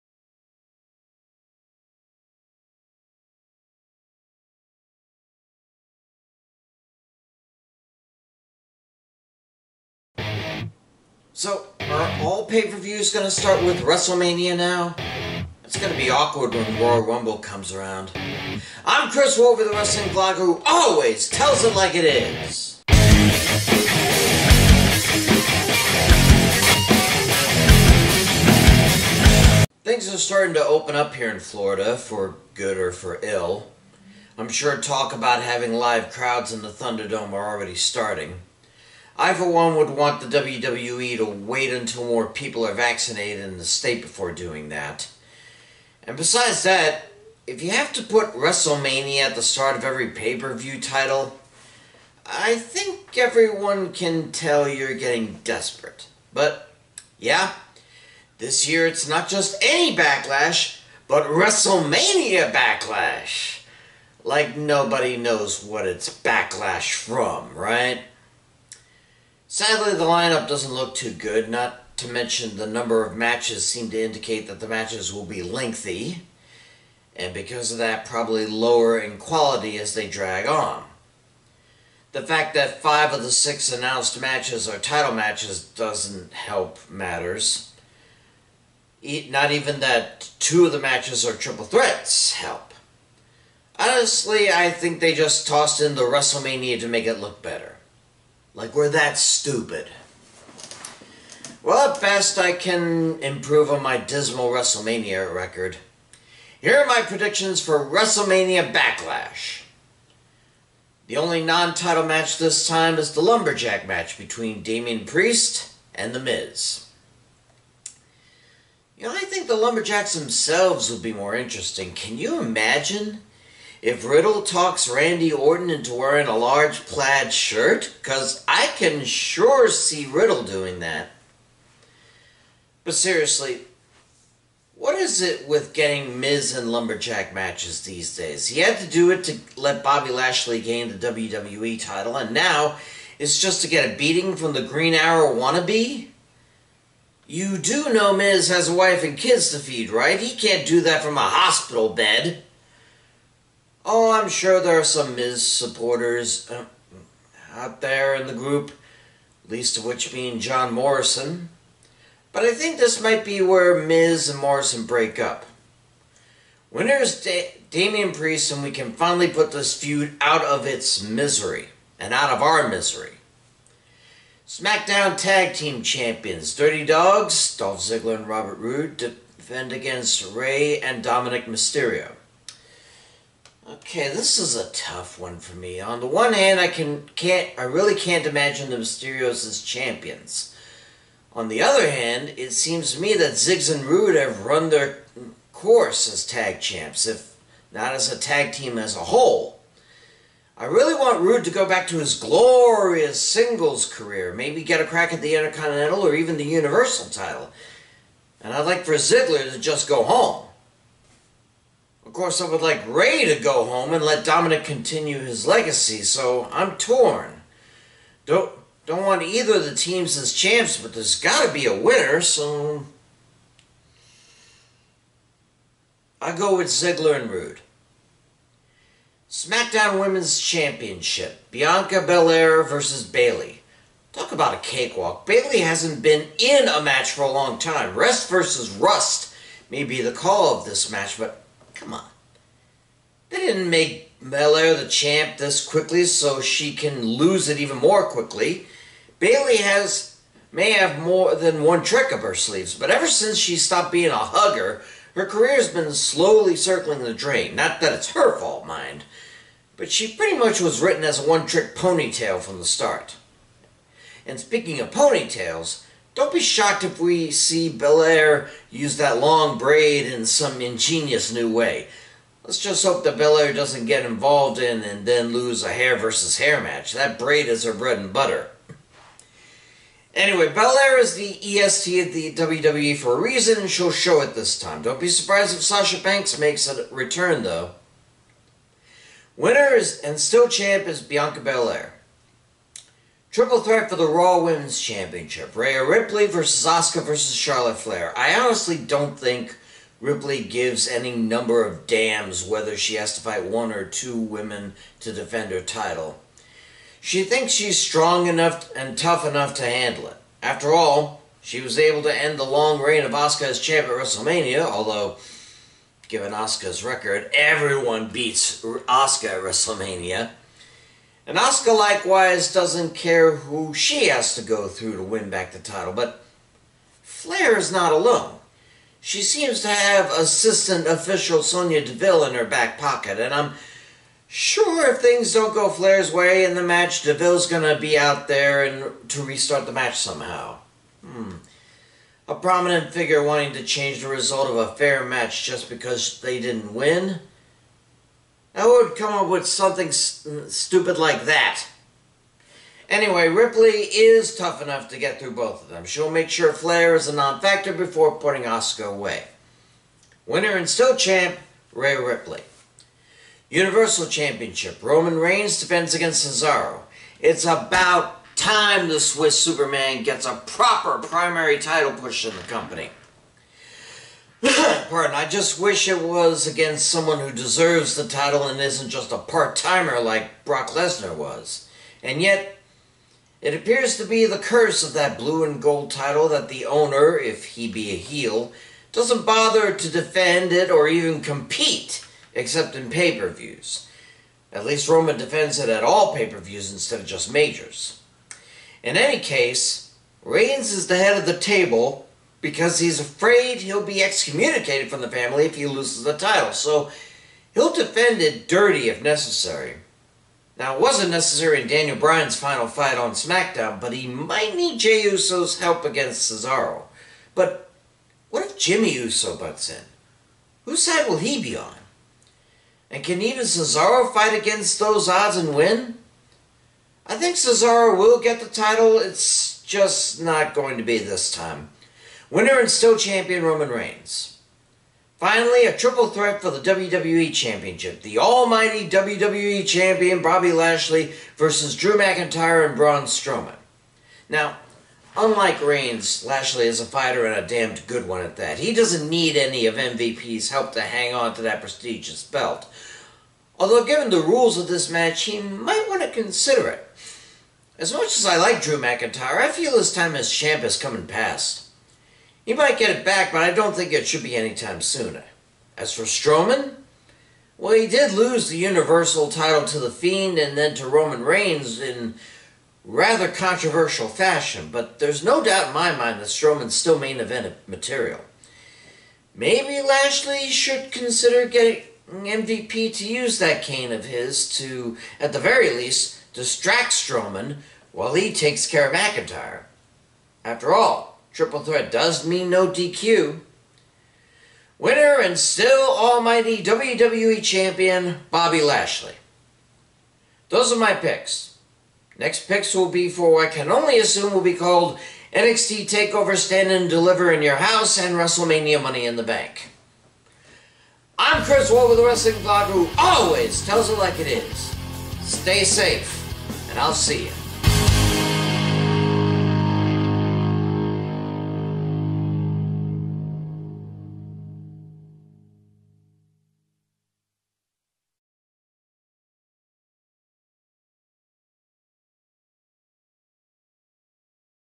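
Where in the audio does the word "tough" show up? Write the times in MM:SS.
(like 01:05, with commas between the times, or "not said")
03:04, 05:08, 05:54.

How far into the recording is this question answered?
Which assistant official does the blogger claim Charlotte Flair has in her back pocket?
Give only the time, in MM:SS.
05:31.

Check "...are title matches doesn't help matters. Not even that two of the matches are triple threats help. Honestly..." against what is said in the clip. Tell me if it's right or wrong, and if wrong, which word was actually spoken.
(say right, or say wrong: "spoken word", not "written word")
right.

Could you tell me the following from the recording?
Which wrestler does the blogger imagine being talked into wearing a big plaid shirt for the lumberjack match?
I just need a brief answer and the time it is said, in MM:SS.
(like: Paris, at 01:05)
Randy Orton, at 02:04.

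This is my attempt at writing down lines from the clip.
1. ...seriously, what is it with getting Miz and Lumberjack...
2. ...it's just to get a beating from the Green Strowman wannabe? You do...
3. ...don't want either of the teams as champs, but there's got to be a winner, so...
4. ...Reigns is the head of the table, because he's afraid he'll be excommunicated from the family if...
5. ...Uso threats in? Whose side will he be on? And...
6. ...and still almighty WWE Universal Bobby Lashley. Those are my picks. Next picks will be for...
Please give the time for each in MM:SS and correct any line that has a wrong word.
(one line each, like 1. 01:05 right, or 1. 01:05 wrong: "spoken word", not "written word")
1. 02:12 right
2. 02:23 wrong: "Arrow", not "Strowman"
3. 03:38 right
4. 06:40 right
5. 06:58 wrong: "butts", not "threats"
6. 08:15 wrong: "Champion", not "Universal".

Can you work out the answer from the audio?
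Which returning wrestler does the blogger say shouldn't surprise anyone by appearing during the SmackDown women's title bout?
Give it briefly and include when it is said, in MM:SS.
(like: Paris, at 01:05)
Sasha Banks, at 04:45.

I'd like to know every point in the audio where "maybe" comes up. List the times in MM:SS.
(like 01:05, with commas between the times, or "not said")
03:24, 07:59.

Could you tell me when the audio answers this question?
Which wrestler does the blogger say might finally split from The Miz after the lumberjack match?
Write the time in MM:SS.
02:40.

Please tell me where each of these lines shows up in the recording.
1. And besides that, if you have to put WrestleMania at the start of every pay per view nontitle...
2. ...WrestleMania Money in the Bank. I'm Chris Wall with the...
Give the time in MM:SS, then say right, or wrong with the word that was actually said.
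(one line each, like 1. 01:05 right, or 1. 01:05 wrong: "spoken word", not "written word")
1. 00:46 wrong: "title", not "nontitle"
2. 08:28 right.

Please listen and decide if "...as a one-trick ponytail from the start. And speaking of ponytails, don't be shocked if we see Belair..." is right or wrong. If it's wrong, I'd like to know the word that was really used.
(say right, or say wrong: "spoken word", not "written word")
right.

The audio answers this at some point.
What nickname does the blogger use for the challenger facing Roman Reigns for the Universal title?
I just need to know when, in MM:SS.
06:08.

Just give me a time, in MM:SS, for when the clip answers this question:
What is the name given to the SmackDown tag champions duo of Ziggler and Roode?
02:56.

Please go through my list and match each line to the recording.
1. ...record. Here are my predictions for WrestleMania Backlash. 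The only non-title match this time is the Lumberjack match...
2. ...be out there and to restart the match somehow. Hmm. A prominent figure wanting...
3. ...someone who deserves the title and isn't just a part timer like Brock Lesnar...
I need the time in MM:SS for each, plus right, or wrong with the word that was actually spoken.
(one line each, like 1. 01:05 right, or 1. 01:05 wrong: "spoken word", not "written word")
1. 01:45 right
2. 05:37 right
3. 06:16 right.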